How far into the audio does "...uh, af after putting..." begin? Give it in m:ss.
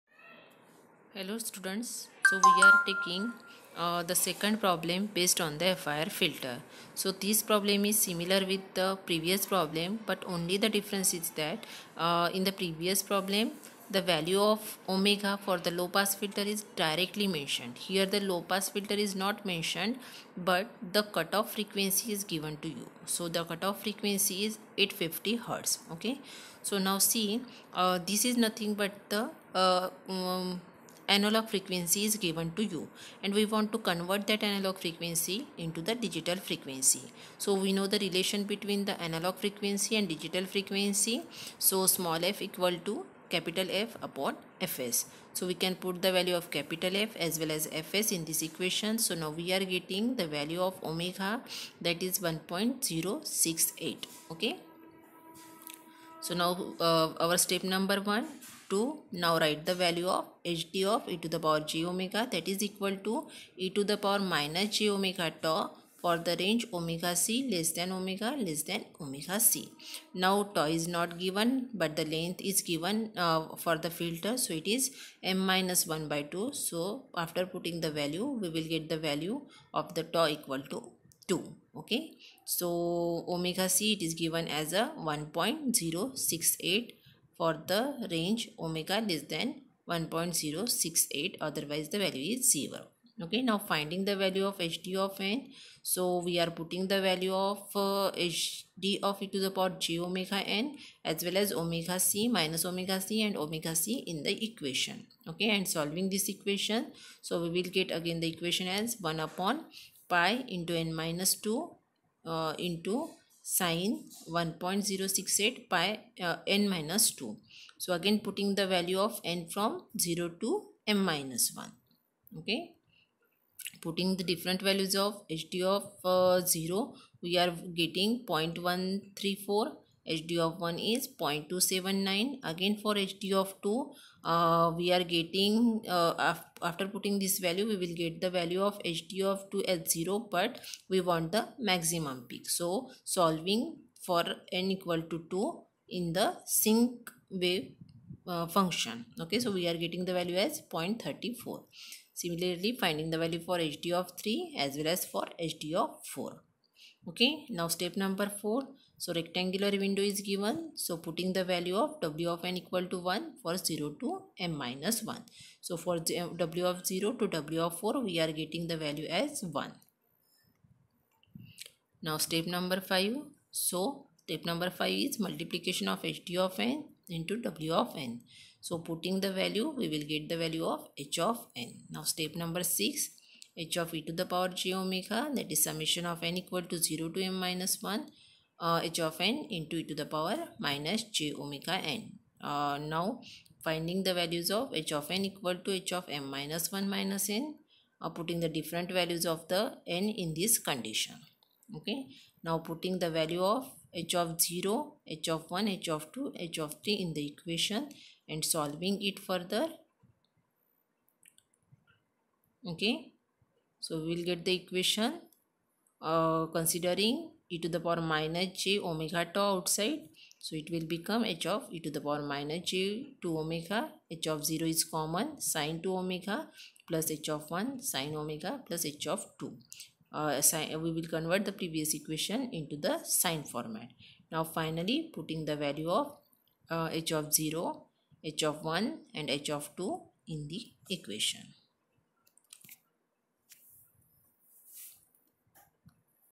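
2:15.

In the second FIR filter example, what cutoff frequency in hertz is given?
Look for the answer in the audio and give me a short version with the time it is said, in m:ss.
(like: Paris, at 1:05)
850 hertz, at 0:24.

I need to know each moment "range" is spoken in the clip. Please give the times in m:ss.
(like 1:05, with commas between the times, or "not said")
1:06, 1:28.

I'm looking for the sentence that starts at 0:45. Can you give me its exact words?
So we can put the value of capital F as well as Fs in this equation.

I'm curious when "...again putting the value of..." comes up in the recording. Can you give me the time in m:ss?
1:57.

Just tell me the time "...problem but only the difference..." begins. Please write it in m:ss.
0:09.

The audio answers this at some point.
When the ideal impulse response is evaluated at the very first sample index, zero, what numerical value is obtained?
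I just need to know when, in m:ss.
2:08.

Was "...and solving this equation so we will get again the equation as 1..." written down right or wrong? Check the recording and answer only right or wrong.
right.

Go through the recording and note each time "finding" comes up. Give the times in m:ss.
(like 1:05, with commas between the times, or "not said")
1:33, 2:32, 3:13.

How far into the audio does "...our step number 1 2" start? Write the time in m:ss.
0:57.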